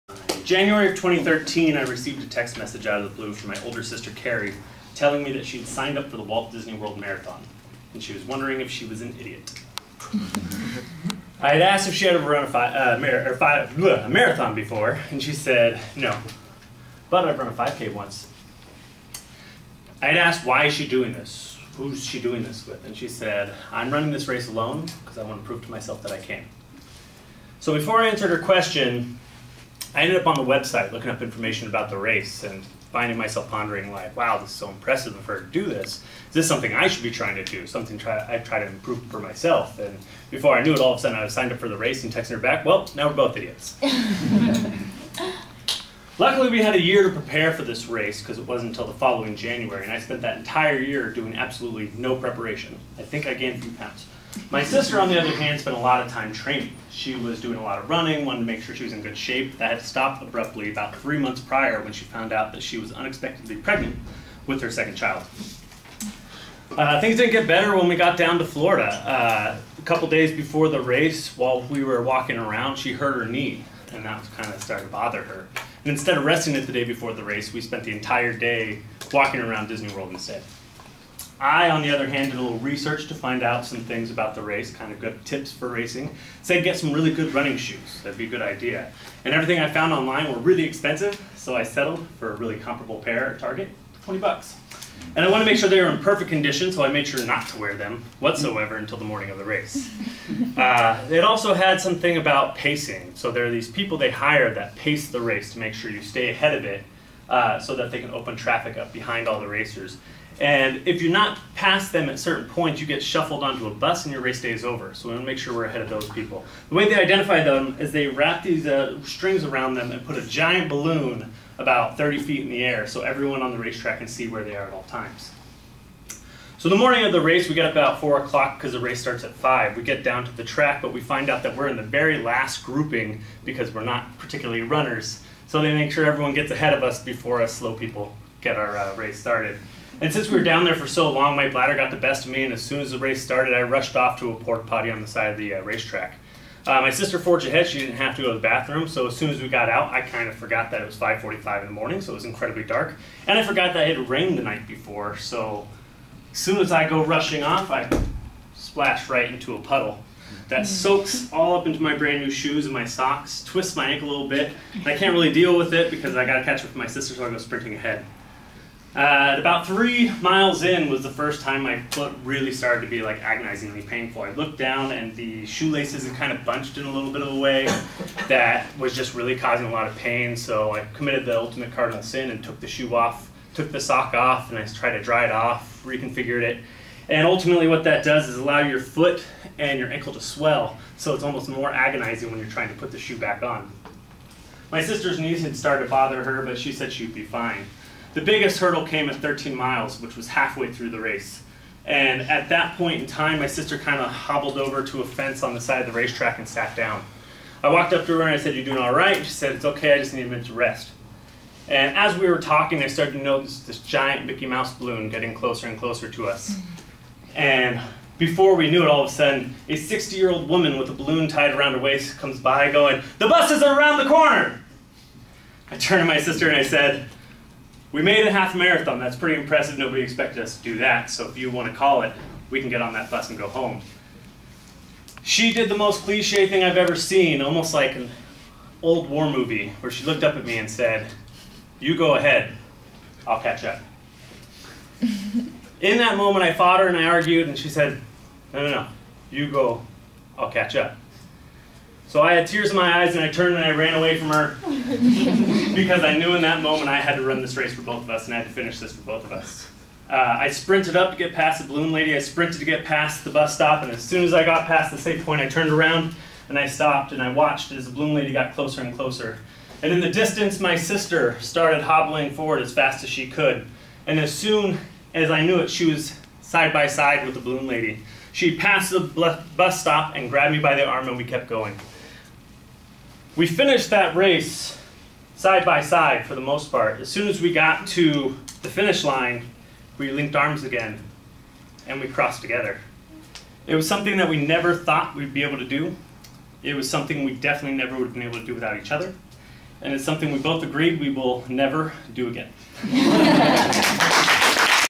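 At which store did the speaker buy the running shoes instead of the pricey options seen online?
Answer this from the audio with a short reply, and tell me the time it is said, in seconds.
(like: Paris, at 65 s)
Target, at 93 s.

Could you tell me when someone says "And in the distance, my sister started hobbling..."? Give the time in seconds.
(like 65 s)
269 s.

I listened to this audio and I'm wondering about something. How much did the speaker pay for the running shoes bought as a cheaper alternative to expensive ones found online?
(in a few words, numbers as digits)
$20.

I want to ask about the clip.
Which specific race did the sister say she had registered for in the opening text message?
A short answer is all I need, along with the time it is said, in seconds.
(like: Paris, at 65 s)
Walt Disney World Marathon, at 6 s.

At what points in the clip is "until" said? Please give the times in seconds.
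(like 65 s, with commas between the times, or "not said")
48 s, 98 s.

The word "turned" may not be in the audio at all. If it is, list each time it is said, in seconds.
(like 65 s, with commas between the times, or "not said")
225 s, 253 s, 265 s.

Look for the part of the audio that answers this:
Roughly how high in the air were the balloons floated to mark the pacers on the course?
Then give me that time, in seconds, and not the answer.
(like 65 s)
121 s.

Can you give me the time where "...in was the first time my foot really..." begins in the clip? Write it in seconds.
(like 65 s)
170 s.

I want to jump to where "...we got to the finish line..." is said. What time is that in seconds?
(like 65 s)
287 s.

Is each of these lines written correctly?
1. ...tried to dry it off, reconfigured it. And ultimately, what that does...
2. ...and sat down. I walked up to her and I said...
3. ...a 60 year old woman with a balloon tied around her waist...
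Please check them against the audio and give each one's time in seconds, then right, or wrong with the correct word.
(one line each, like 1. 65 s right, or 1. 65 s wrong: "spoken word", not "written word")
1. 184 s right
2. 206 s right
3. 219 s right.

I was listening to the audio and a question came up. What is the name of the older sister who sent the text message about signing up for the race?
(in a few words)
Carrie.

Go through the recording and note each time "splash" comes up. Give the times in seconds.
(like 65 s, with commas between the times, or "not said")
158 s.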